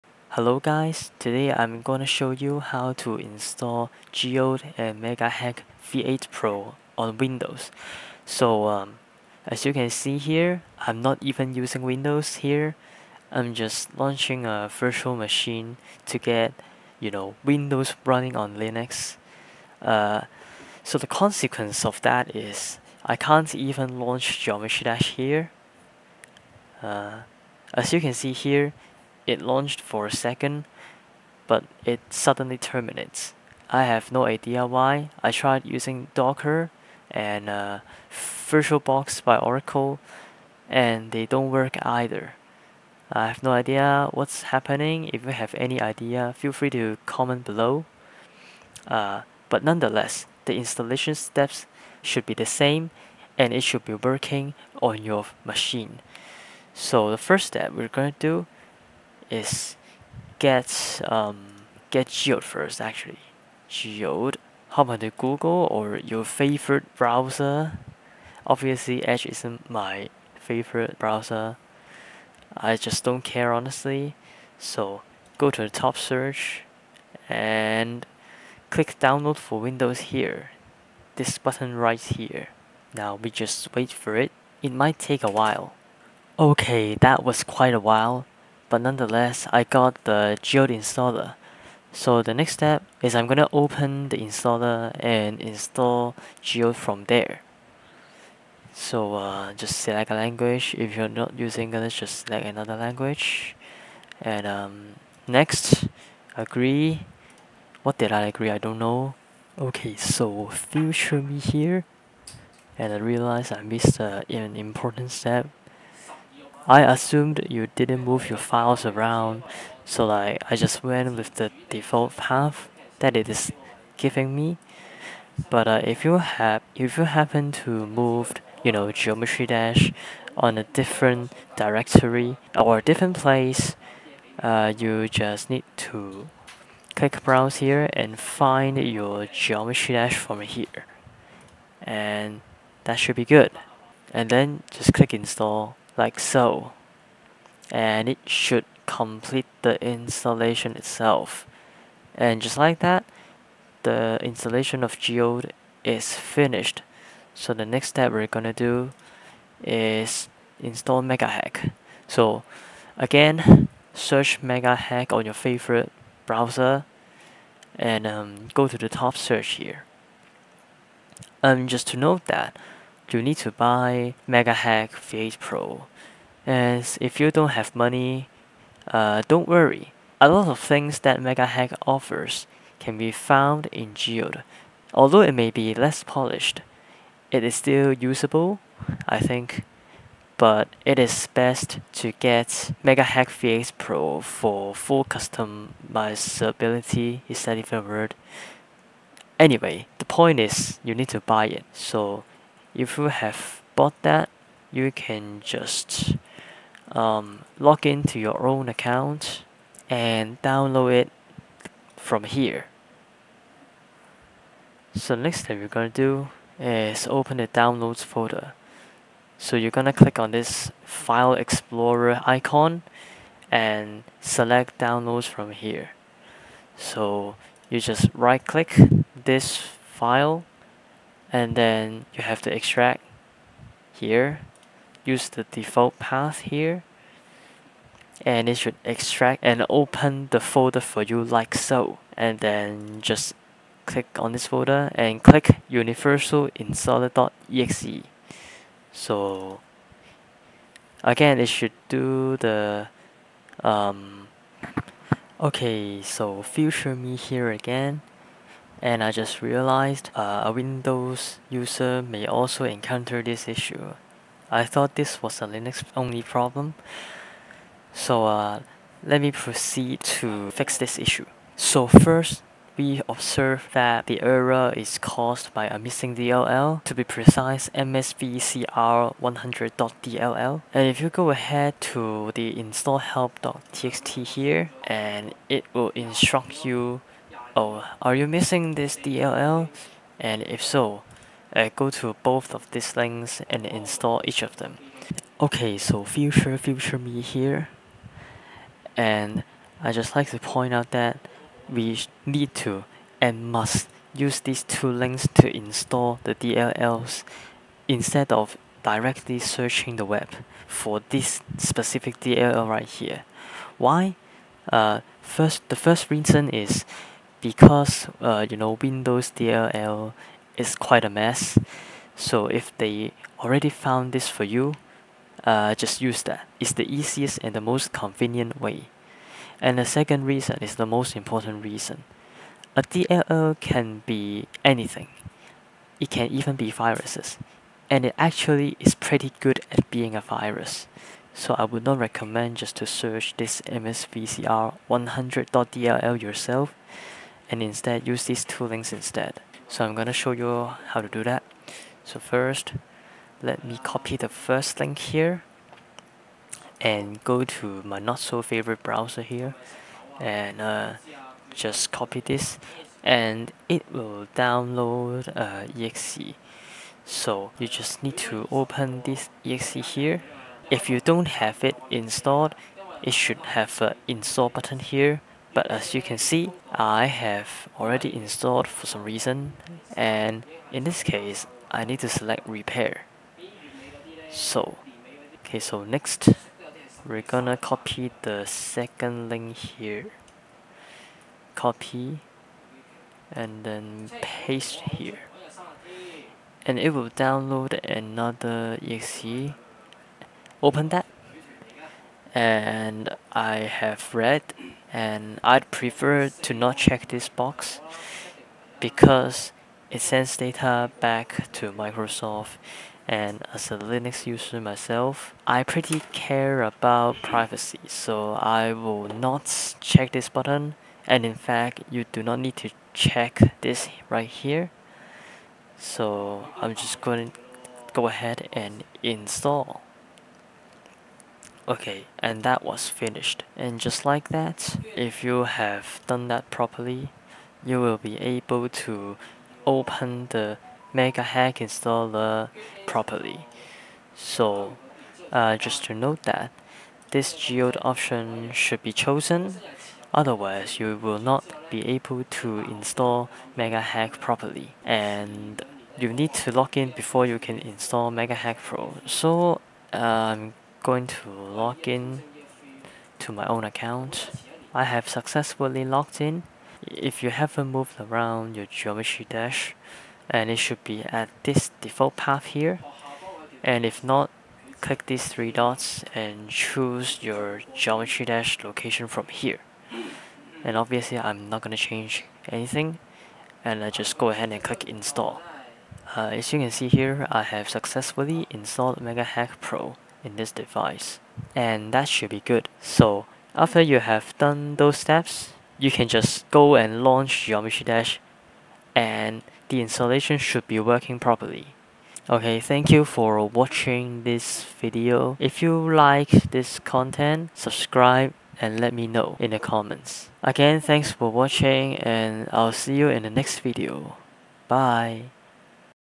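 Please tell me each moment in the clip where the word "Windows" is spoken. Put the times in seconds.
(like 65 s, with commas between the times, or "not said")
7 s, 11 s, 17 s, 79 s, 260 s, 318 s.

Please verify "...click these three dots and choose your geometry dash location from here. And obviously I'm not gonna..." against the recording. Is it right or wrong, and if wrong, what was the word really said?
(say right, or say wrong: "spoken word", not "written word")
right.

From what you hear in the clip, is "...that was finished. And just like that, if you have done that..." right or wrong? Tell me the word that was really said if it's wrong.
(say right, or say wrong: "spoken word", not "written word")
right.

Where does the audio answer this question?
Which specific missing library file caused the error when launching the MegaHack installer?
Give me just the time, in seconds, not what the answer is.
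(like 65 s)
277 s.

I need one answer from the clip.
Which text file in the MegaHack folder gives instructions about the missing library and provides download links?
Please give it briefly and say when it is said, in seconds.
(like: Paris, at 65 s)
install help.txt, at 282 s.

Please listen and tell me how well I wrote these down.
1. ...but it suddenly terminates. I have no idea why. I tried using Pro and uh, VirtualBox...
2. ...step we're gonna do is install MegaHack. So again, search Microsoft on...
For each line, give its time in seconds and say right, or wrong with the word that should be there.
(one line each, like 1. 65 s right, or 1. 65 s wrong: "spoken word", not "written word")
1. 31 s wrong: "Docker", not "Pro"
2. 157 s wrong: "MegaHack", not "Microsoft".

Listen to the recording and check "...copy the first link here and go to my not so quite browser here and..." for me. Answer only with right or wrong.
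wrong.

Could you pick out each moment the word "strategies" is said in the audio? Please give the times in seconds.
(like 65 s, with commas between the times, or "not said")
not said.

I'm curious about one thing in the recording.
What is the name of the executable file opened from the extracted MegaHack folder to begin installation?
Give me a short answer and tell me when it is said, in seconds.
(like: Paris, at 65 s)
universal installer.exe, at 245 s.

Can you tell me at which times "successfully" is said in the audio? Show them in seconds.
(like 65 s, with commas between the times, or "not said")
465 s, 487 s.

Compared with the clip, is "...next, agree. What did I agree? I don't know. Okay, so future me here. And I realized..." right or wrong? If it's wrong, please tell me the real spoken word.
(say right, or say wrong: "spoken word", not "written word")
right.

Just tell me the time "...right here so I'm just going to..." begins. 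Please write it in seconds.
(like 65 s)
424 s.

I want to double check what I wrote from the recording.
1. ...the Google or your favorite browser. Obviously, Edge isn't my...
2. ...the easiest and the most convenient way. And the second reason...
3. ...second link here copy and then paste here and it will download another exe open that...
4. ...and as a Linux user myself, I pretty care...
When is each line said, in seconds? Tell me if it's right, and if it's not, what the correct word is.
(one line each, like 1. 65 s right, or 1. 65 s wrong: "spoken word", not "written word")
1. 64 s right
2. 326 s right
3. 388 s right
4. 413 s right.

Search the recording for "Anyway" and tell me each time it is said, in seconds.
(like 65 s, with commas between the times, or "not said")
199 s.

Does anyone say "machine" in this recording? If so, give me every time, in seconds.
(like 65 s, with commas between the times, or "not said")
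15 s, 55 s.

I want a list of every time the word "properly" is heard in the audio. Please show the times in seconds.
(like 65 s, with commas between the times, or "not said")
436 s, 442 s, 454 s, 501 s.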